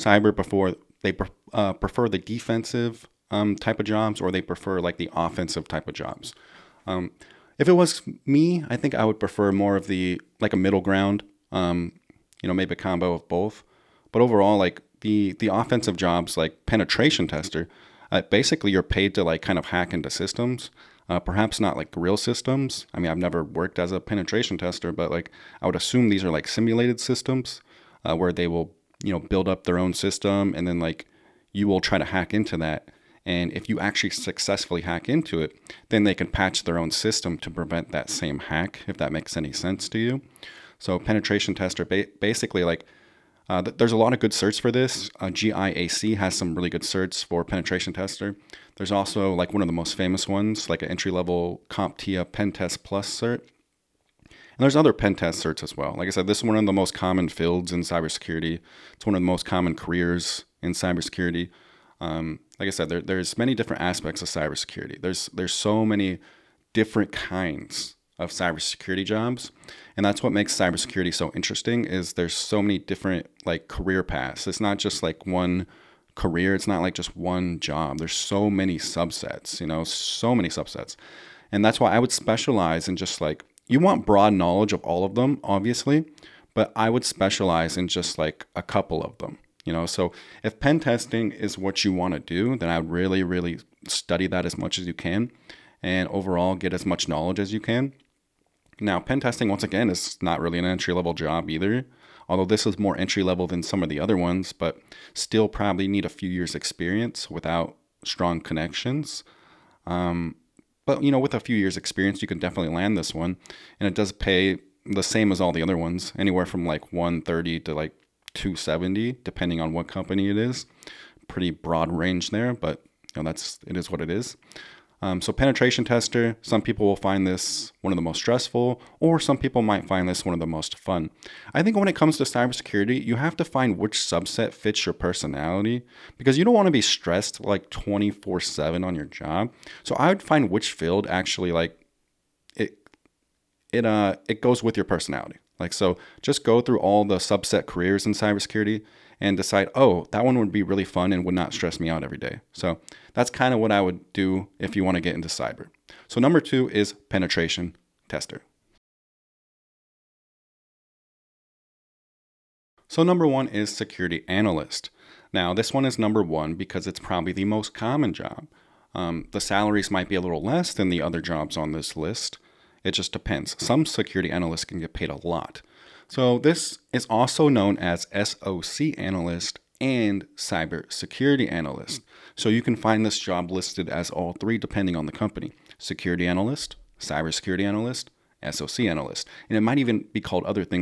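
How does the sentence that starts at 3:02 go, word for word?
So you can find this job listed as all three depending on the company.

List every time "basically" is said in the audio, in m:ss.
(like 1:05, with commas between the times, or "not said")
0:18, 0:42.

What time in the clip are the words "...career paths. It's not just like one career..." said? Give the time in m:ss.
1:13.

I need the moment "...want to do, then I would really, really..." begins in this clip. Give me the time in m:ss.
1:31.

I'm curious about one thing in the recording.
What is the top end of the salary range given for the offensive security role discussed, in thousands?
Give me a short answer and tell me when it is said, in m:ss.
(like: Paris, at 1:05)
270, at 1:58.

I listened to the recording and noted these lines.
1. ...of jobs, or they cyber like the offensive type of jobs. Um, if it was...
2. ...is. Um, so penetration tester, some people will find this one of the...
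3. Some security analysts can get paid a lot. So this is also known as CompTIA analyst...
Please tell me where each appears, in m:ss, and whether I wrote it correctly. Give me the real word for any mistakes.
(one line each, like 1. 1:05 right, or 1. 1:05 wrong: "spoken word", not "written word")
1. 0:03 wrong: "prefer", not "cyber"
2. 2:04 right
3. 2:53 wrong: "SOC", not "CompTIA".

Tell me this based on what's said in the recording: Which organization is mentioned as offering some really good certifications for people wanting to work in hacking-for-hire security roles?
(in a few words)
GIAC.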